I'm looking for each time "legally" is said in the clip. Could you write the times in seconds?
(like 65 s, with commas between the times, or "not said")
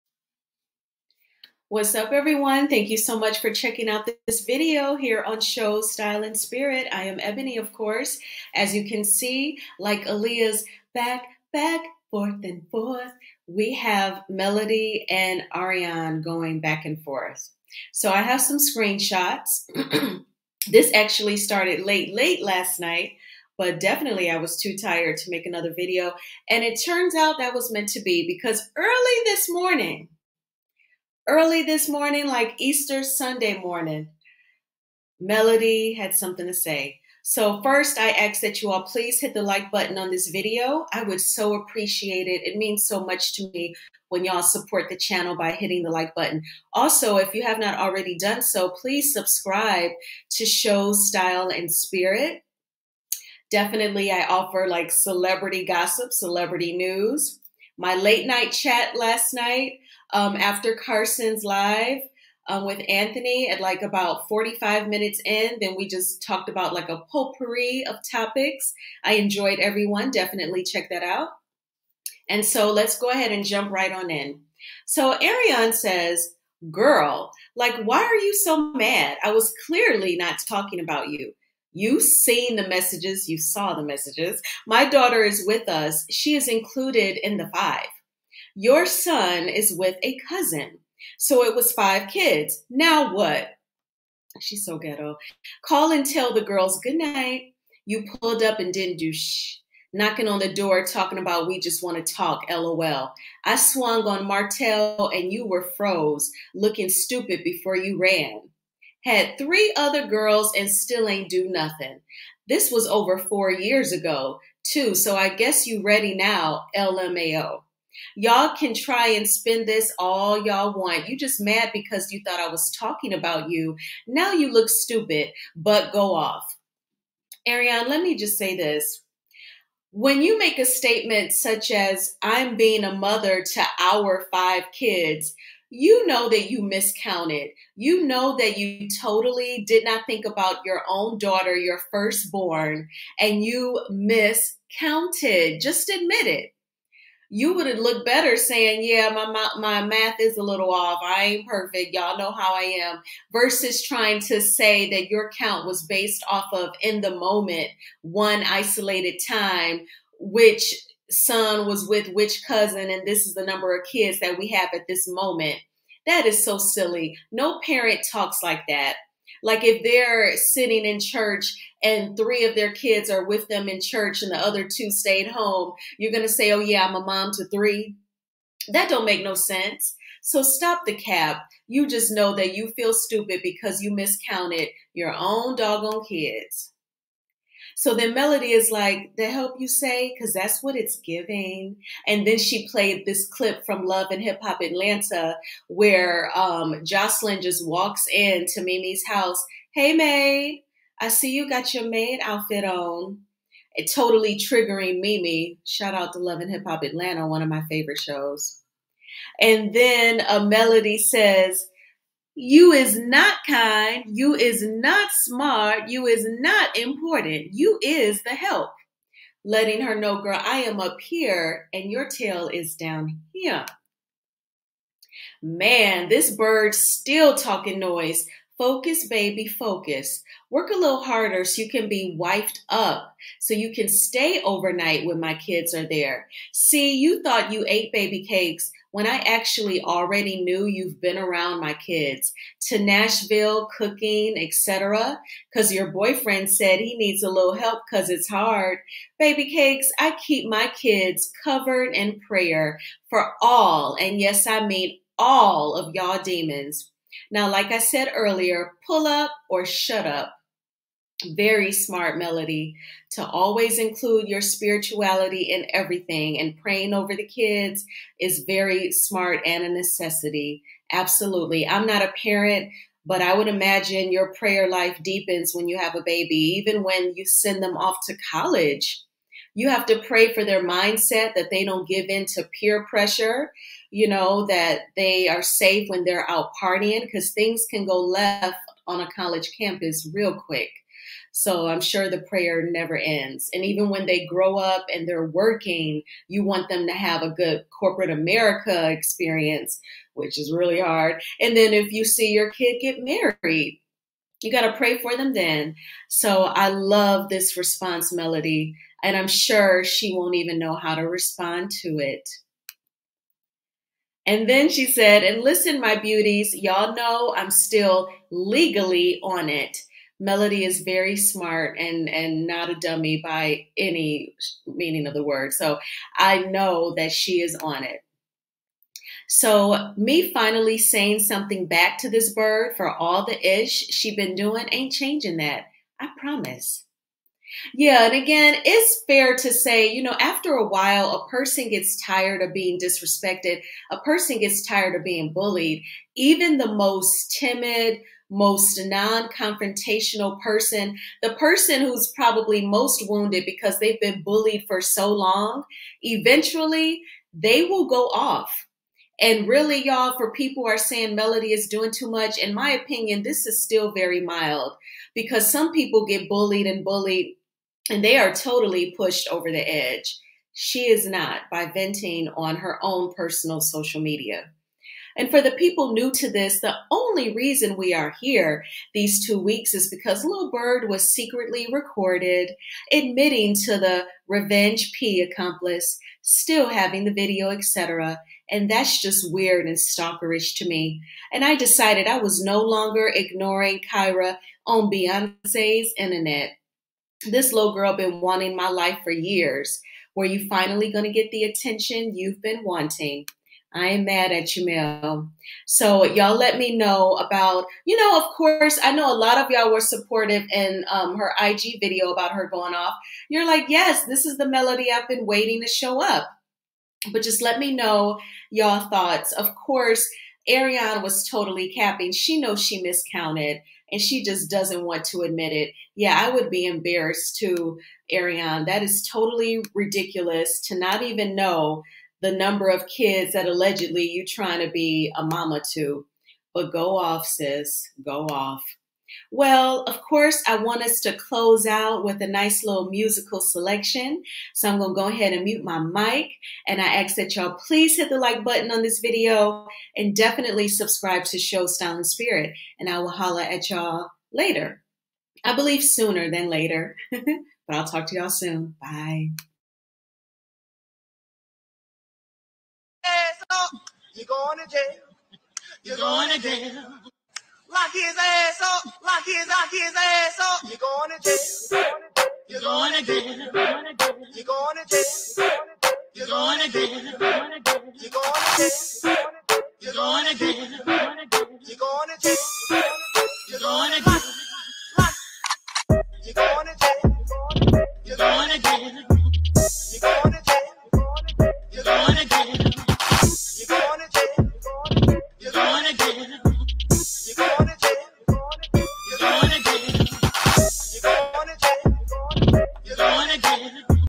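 318 s.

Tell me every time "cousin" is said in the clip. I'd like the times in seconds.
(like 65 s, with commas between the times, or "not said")
90 s, 162 s.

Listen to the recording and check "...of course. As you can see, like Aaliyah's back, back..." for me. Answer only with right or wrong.
right.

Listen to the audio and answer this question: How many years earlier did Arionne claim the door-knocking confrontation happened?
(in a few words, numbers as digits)
4.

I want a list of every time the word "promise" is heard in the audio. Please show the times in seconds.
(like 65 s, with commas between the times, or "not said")
336 s.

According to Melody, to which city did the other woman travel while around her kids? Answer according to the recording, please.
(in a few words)
Nashville.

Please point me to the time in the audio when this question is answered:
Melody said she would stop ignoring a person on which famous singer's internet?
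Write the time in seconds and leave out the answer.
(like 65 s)
394 s.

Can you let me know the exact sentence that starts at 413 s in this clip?
You're like, yes, this is the melody I've been waiting to show up.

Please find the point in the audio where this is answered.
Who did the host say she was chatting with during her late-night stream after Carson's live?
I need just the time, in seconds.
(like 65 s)
62 s.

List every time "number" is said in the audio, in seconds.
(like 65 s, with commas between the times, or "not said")
163 s, 432 s.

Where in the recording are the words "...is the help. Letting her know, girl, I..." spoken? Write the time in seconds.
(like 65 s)
217 s.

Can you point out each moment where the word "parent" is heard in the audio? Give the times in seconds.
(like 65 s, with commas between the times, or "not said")
167 s, 272 s.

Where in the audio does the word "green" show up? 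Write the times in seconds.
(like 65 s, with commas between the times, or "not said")
not said.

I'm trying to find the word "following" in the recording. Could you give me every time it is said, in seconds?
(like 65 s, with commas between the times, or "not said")
not said.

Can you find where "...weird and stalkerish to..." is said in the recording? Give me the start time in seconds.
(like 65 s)
389 s.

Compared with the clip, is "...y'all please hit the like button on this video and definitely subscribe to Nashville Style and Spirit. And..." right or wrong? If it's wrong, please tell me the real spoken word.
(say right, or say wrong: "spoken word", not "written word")
wrong: "Show", not "Nashville".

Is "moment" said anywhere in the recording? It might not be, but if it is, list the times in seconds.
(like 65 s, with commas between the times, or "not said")
157 s, 165 s.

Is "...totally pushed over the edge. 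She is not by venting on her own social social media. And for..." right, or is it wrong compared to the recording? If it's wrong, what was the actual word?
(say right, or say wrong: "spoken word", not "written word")
wrong: "personal", not "social".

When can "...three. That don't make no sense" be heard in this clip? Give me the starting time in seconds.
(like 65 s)
177 s.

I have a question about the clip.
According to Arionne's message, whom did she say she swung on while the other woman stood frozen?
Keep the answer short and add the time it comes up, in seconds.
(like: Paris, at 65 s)
Martell, at 104 s.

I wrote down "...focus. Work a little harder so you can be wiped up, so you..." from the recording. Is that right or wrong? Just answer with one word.
right.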